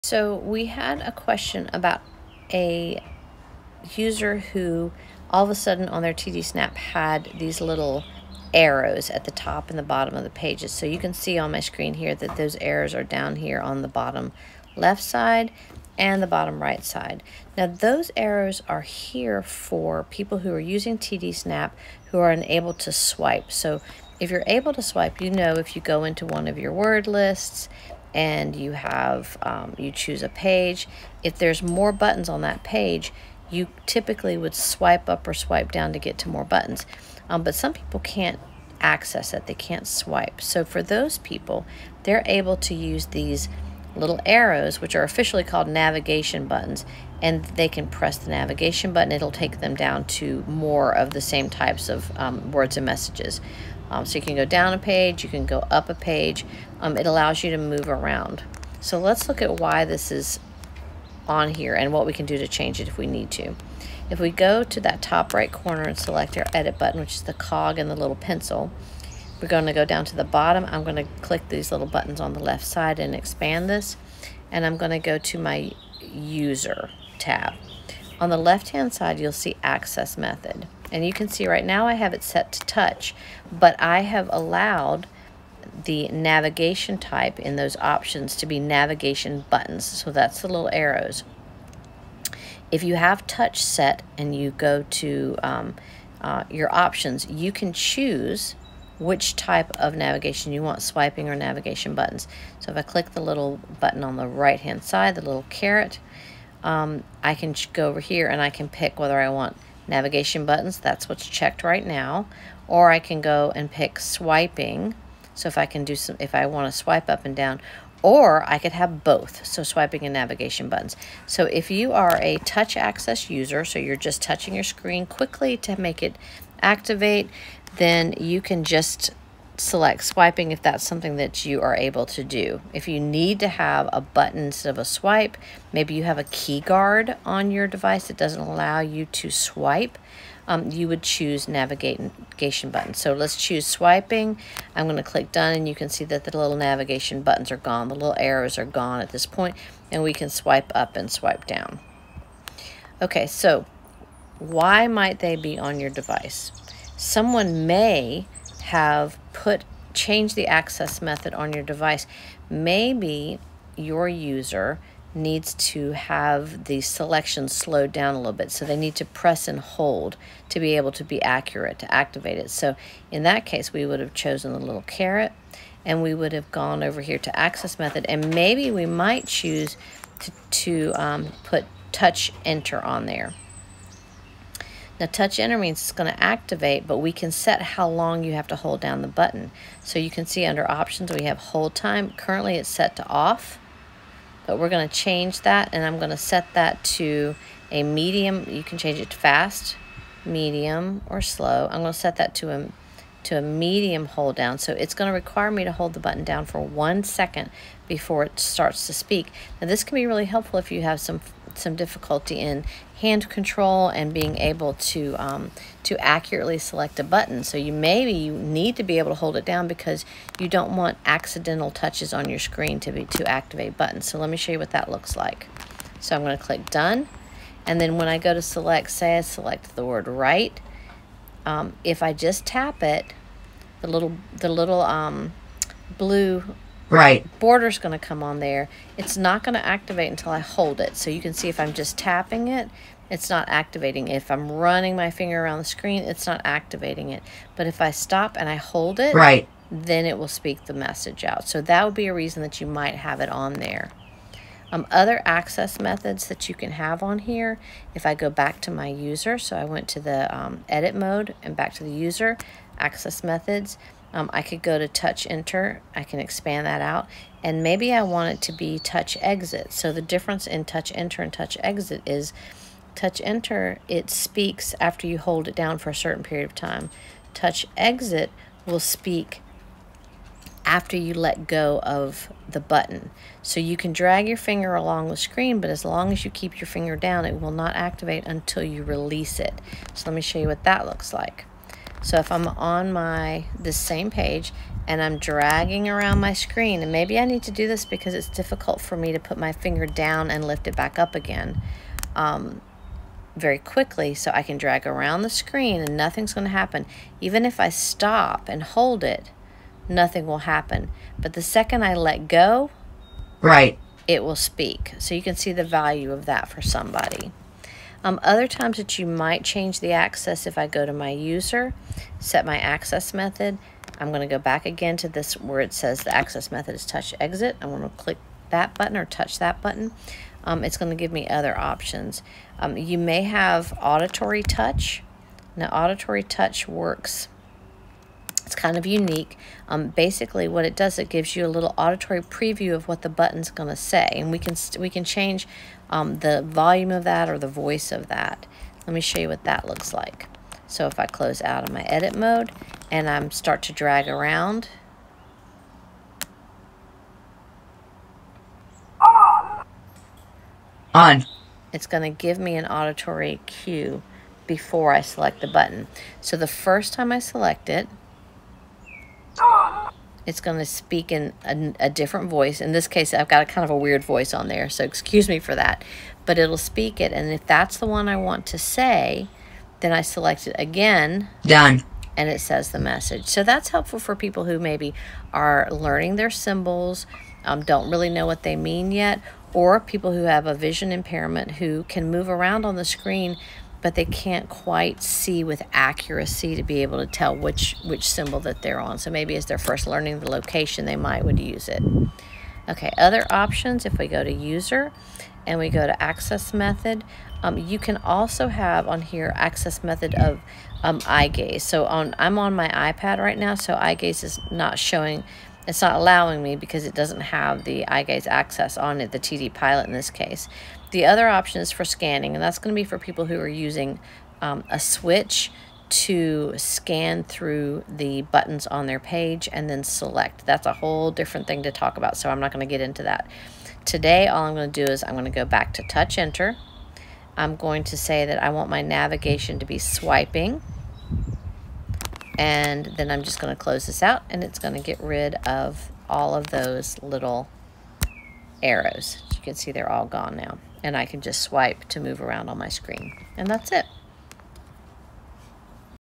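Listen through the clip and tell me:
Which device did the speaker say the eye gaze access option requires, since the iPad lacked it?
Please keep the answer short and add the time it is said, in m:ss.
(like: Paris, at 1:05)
TD Pilot, at 6:59.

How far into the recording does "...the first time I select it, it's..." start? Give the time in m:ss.
6:06.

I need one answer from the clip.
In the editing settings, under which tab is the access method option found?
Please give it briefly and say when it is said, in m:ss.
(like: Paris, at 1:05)
user tab, at 1:16.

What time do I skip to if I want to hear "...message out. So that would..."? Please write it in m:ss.
4:10.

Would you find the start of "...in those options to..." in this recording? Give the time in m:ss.
1:27.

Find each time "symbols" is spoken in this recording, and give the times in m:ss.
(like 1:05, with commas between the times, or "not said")
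6:26, 6:38.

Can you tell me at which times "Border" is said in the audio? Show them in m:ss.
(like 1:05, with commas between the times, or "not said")
3:57.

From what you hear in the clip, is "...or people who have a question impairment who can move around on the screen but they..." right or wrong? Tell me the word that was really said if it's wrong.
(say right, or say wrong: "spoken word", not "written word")
wrong: "vision", not "question".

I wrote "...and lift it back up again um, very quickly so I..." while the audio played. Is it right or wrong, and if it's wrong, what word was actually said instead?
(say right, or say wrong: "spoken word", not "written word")
right.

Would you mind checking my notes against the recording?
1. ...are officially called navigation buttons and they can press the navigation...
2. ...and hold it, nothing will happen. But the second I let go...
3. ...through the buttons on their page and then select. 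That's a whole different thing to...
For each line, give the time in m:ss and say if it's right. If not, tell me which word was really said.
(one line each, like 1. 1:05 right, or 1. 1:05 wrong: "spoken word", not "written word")
1. 0:44 right
2. 5:08 right
3. 7:07 right.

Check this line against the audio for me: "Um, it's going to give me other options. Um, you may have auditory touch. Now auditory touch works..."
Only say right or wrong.
right.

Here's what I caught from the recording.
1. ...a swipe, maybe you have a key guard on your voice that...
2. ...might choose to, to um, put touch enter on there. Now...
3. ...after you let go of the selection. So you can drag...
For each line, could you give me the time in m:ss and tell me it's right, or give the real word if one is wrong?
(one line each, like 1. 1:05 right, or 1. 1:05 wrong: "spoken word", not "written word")
1. 2:14 wrong: "device", not "voice"
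2. 2:58 right
3. 4:40 wrong: "button", not "selection".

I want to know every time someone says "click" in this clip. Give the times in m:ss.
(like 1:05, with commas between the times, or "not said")
1:11, 1:42, 2:25, 3:46, 5:27.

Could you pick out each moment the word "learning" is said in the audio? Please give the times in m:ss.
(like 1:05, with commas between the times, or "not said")
6:25, 6:39.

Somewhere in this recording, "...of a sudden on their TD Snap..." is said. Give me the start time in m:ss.
0:05.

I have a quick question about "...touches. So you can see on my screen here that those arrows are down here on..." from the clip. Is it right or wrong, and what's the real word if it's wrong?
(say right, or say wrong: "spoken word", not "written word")
wrong: "pages", not "touches".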